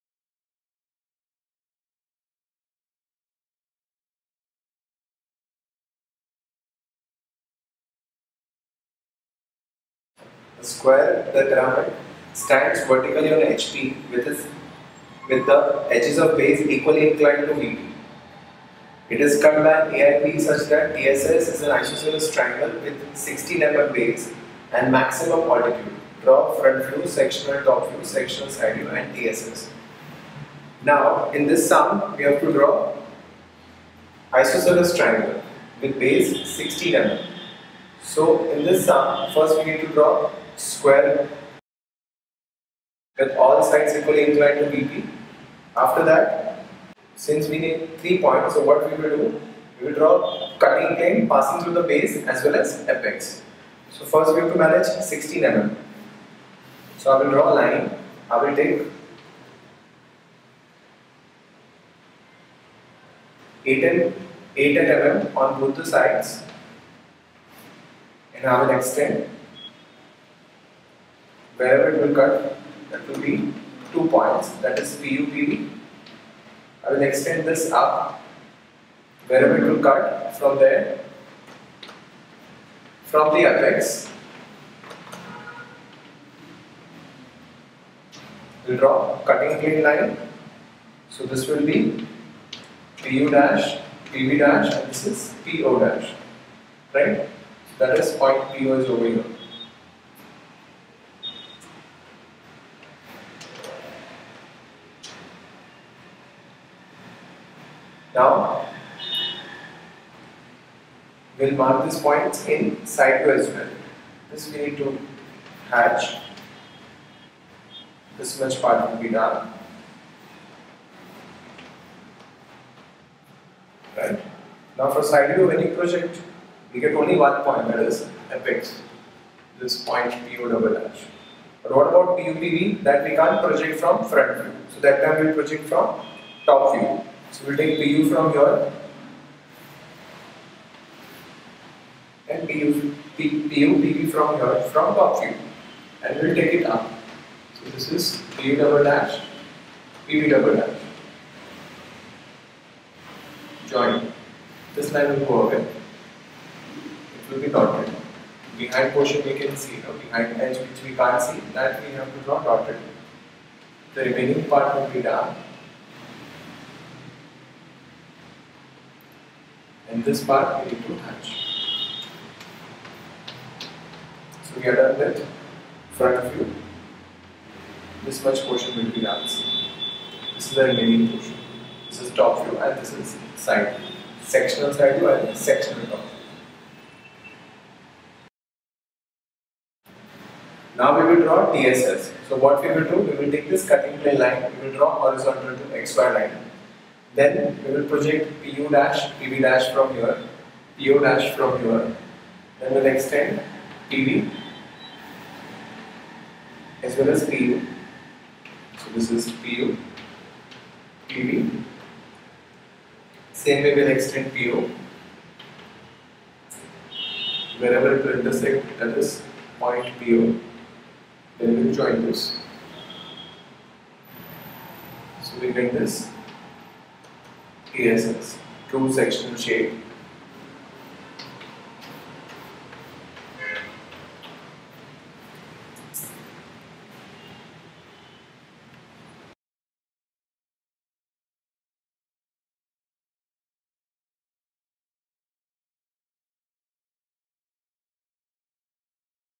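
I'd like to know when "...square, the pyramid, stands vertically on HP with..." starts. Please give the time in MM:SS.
00:10.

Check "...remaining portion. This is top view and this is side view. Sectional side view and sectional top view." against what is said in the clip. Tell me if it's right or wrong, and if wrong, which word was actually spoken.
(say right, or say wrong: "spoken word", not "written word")
right.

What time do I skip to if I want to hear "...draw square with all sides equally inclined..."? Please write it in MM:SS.
00:39.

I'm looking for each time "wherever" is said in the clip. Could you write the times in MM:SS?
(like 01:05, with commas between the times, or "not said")
01:11, 01:19, 03:37.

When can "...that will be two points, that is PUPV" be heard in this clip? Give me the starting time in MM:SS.
01:12.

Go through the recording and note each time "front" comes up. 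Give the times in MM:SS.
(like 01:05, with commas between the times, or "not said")
00:26, 02:14, 02:55.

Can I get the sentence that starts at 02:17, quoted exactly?
So we'll take PU from here and PU, P, PU PV from here from top view and we'll take it up.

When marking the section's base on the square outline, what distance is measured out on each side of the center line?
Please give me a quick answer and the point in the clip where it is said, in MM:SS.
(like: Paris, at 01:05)
8 mm, at 01:03.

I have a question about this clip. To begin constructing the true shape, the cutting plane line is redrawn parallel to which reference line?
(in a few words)
XY line.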